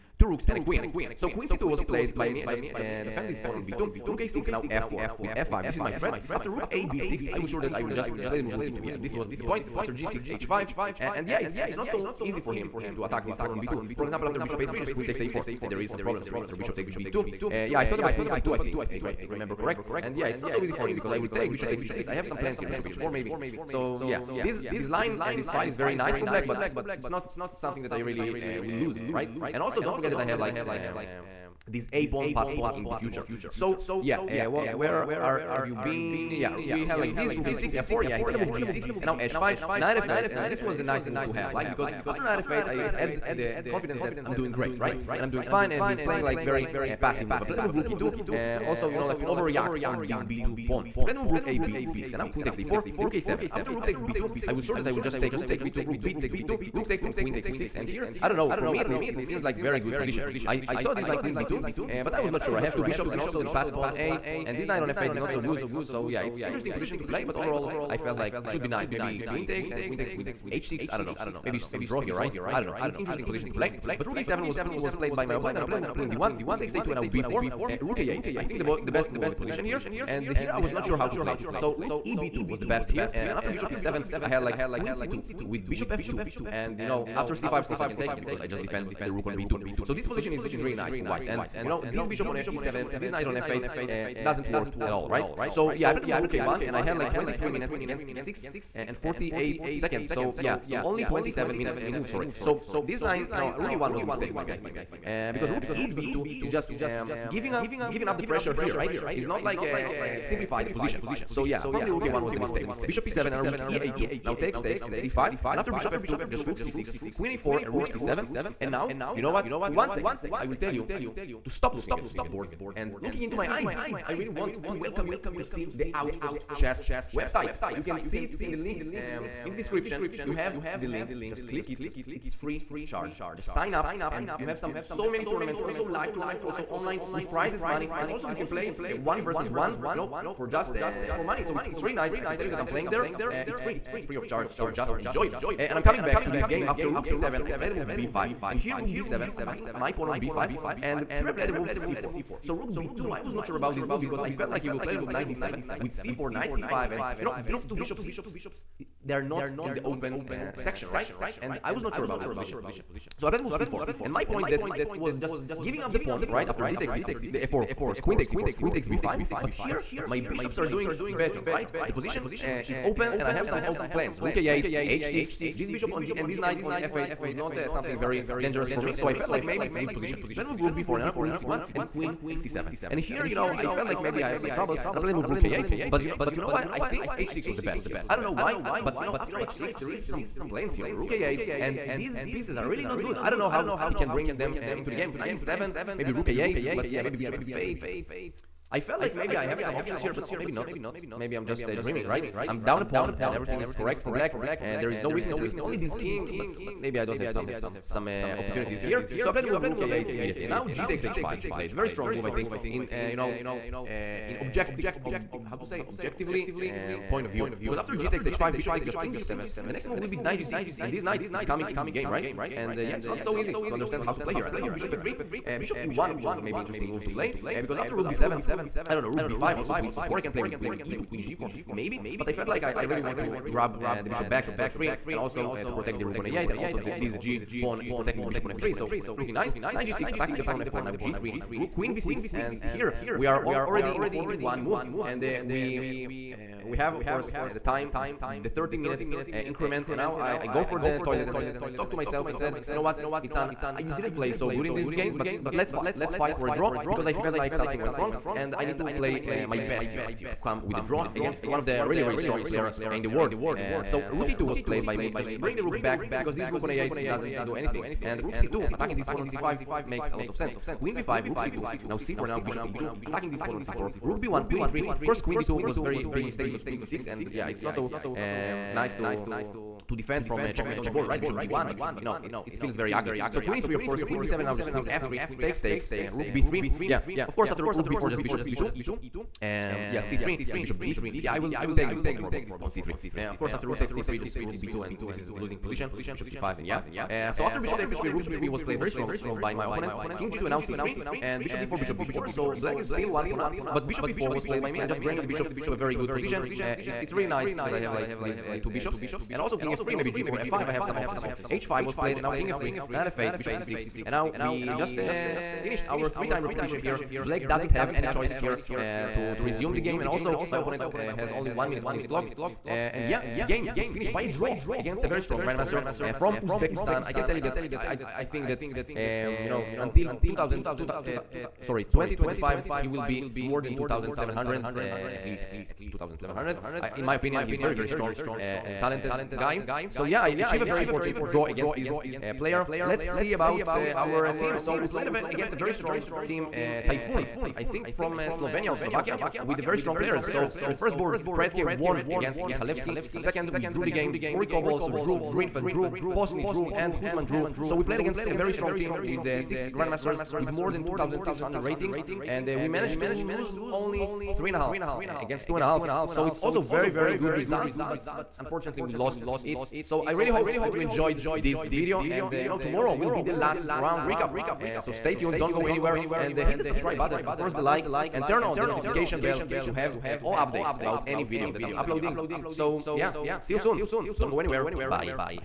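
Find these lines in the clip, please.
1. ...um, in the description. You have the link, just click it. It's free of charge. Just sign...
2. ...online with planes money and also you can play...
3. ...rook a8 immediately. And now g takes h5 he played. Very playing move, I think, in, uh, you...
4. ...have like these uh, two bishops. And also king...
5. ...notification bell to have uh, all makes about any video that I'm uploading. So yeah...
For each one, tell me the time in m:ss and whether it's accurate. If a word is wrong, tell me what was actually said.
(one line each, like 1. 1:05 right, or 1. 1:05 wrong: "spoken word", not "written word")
1. 2:08 right
2. 2:16 wrong: "prizes", not "planes"
3. 3:29 wrong: "strong", not "playing"
4. 5:07 right
5. 6:18 wrong: "updates", not "makes".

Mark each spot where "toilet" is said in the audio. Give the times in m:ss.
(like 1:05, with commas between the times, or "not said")
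4:11.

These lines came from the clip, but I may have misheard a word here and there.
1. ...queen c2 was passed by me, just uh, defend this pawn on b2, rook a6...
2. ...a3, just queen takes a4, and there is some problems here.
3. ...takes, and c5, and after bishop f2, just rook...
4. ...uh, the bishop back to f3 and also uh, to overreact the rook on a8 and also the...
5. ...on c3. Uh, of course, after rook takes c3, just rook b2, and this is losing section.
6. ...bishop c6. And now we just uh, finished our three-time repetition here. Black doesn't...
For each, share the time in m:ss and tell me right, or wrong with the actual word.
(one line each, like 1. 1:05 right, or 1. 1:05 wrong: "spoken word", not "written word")
1. 0:01 wrong: "played", not "passed"
2. 0:14 right
3. 1:54 right
4. 3:53 wrong: "protect", not "overreact"
5. 4:52 wrong: "position", not "section"
6. 5:13 right.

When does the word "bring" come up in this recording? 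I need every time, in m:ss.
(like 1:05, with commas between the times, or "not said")
3:14, 4:25, 5:05.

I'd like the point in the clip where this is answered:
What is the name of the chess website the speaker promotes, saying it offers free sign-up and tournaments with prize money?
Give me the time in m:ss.
2:05.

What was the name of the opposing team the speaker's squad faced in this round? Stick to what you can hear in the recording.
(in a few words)
Typhoon.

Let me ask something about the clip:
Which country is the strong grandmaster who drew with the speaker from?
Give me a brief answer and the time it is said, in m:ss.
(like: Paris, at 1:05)
Uzbekistan, at 5:26.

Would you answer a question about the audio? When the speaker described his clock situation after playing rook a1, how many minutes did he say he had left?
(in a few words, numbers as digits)
23.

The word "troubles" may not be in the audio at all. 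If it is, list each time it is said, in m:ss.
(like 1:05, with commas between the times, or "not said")
3:04.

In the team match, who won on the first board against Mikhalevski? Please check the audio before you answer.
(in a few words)
Pretke.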